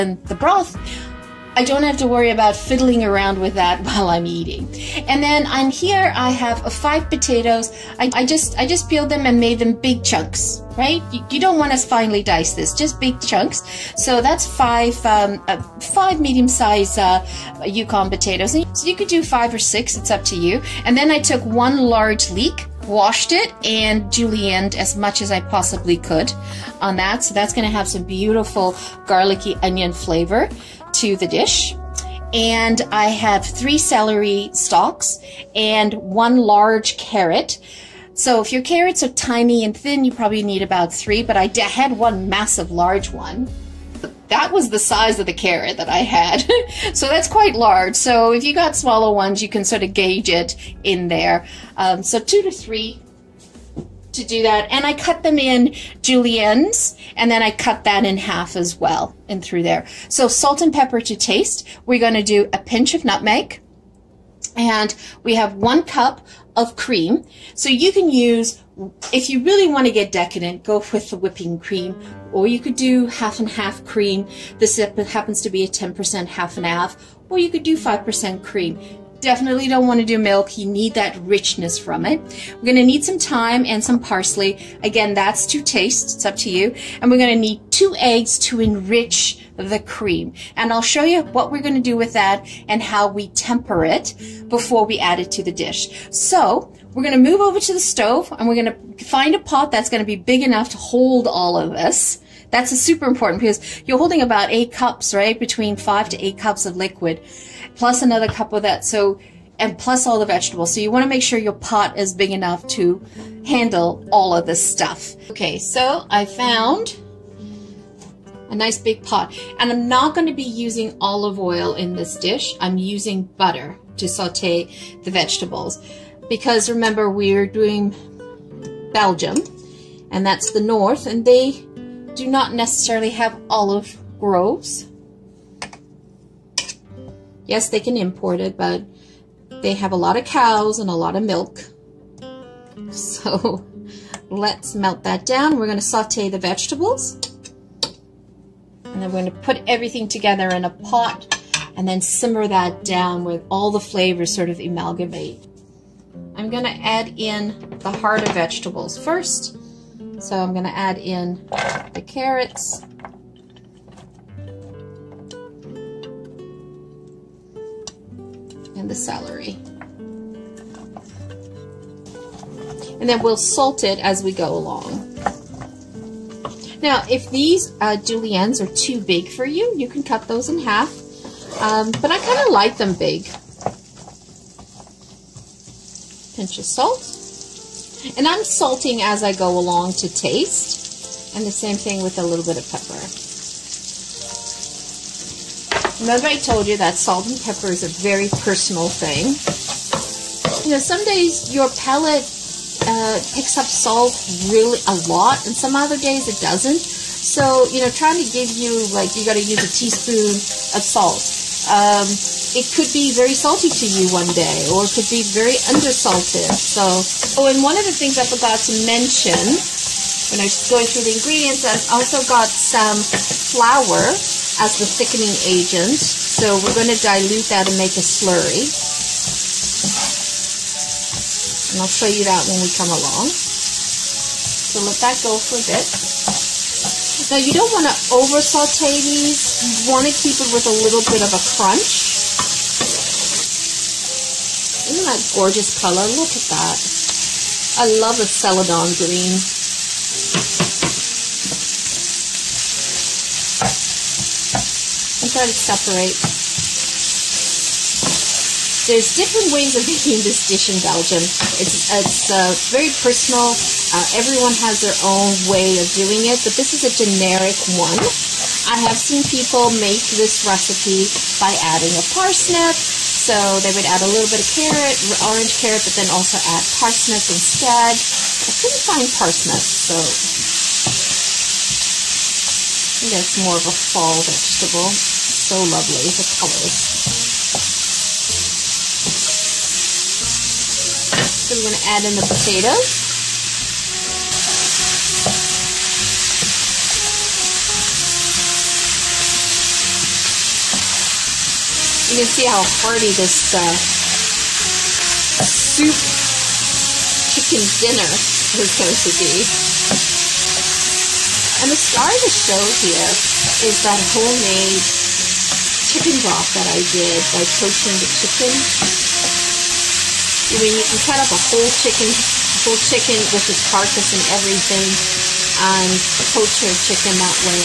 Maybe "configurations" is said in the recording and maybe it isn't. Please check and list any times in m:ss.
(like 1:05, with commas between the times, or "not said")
not said.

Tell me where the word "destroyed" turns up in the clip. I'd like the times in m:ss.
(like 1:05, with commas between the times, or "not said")
not said.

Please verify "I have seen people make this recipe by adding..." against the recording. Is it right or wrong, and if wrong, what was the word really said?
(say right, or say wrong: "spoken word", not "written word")
right.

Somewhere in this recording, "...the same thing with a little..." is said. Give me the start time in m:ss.
3:11.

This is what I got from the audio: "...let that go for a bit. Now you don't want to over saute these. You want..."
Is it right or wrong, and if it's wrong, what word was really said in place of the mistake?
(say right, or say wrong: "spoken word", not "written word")
right.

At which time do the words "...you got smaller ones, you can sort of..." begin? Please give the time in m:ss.
0:48.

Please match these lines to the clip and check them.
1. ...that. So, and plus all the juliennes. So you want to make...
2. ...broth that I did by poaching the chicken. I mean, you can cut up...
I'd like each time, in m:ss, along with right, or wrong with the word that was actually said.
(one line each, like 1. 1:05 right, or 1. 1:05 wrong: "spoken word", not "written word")
1. 1:48 wrong: "vegetables", not "juliennes"
2. 5:16 right.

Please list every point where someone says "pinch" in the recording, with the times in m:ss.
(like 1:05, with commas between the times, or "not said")
1:02, 3:06.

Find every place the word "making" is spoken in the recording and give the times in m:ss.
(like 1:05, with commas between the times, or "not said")
4:19.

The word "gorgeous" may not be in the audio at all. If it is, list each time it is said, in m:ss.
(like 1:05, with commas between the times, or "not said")
4:05.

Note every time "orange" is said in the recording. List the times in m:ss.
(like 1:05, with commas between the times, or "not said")
4:35.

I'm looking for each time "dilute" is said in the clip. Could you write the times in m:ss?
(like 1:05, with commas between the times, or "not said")
3:46.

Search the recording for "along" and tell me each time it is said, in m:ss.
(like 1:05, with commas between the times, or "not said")
2:54, 3:09, 3:52.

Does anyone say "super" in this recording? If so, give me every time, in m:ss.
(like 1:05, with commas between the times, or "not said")
1:42.